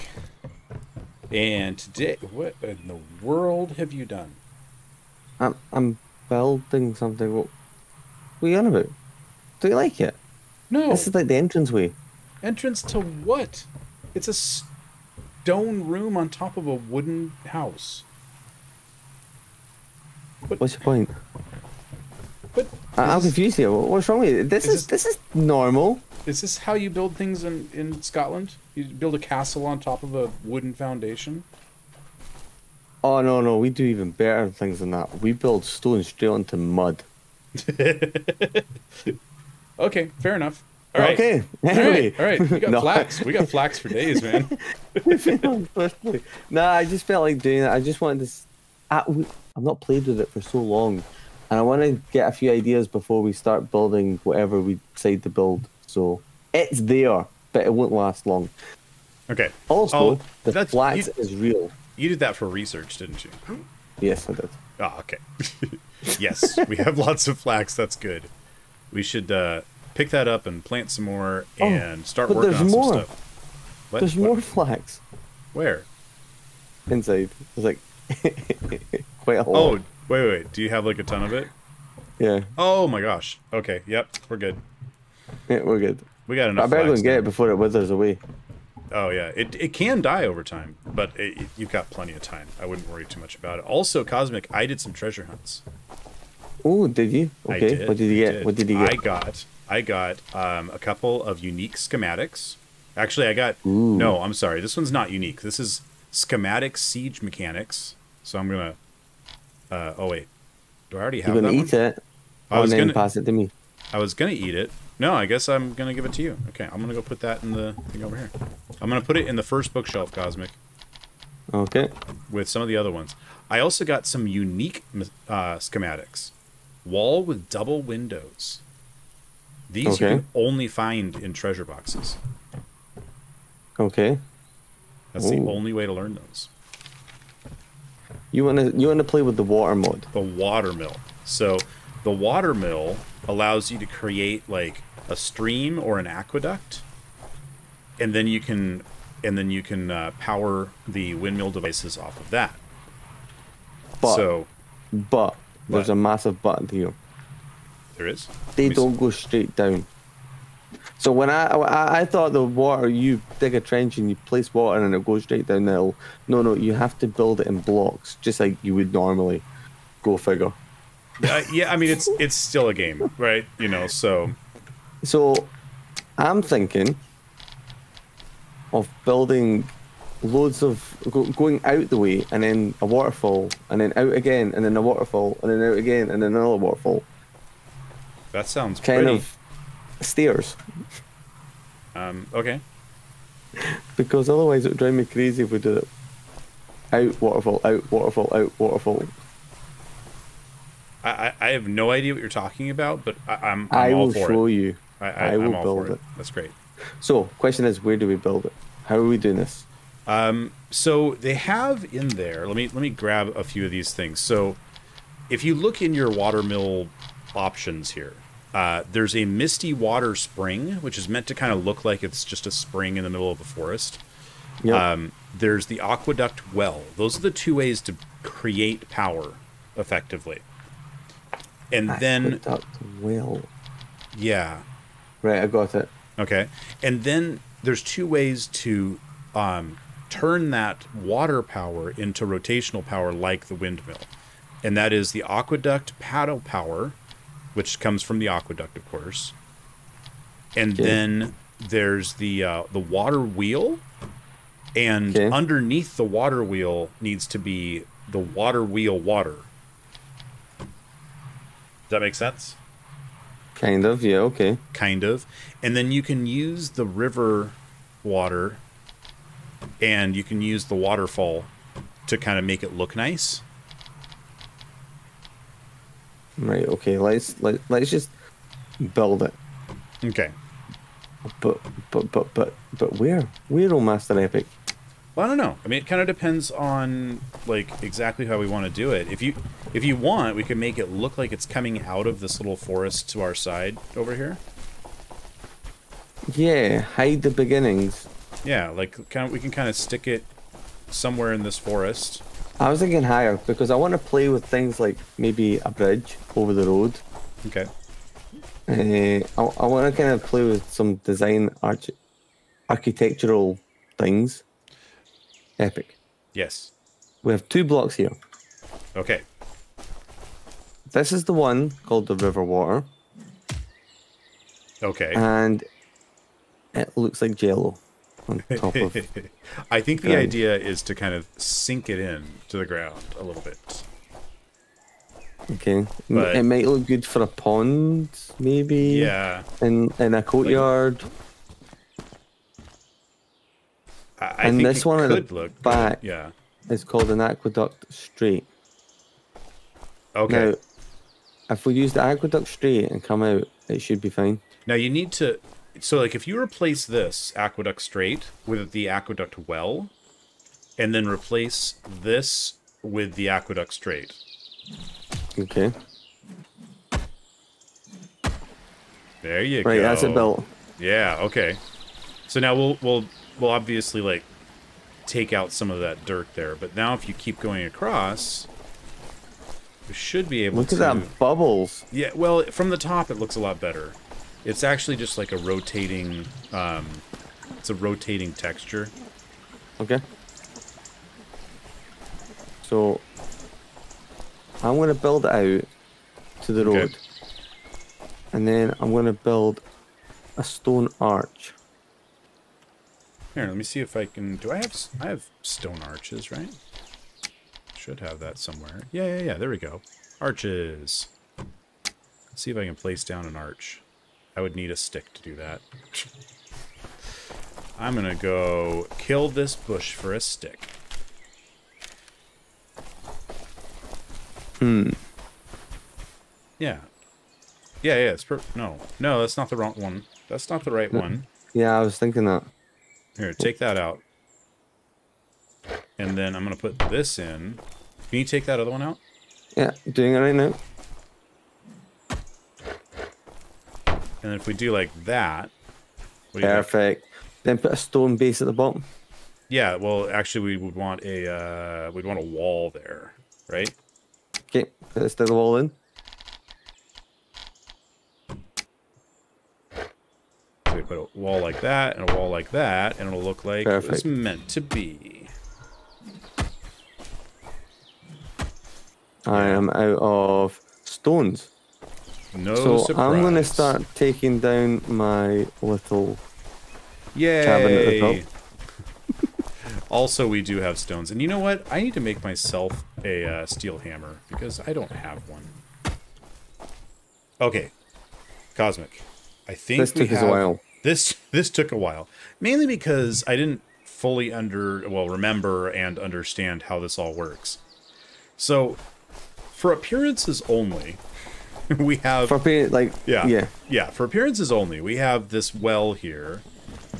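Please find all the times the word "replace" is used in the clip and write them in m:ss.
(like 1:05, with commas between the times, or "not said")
5:56, 6:01.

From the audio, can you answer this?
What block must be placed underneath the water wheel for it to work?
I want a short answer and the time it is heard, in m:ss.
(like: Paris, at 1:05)
Water wheel water, at 4:18.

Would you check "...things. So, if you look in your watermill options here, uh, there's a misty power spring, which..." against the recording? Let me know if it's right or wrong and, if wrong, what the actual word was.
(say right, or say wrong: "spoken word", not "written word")
wrong: "water", not "power".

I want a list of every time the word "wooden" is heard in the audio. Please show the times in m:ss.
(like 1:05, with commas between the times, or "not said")
0:16, 0:30.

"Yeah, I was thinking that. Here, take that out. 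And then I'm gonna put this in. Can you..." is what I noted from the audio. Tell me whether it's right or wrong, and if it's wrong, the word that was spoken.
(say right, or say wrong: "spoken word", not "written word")
right.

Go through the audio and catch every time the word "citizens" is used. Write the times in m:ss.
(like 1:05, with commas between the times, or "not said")
not said.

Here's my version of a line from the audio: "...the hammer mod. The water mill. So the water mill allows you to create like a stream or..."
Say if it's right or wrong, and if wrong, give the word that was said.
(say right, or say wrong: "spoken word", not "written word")
wrong: "water", not "hammer".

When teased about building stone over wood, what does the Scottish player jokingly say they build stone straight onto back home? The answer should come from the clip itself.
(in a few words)
Mud.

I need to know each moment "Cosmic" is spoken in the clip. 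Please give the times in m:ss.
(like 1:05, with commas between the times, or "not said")
1:34, 2:00, 8:08.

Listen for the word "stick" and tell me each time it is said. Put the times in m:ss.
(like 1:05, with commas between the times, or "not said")
4:59, 6:54, 7:00.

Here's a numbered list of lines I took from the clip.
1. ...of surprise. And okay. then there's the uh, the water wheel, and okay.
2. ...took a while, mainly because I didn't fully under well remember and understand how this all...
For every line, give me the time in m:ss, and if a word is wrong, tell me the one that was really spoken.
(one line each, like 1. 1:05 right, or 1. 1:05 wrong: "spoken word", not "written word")
1. 4:08 wrong: "course", not "surprise"
2. 8:11 right.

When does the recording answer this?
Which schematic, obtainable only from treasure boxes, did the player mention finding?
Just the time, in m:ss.
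2:06.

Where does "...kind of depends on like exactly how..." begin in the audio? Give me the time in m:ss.
4:45.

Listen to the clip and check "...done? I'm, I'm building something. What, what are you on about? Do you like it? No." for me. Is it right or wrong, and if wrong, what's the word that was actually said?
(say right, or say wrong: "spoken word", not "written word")
right.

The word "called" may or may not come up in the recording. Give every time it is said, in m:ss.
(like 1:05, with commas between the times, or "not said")
5:21, 5:46.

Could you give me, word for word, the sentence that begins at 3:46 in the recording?
Those are the two ways to create power effectively.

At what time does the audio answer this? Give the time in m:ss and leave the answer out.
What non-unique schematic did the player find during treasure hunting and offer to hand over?
1:46.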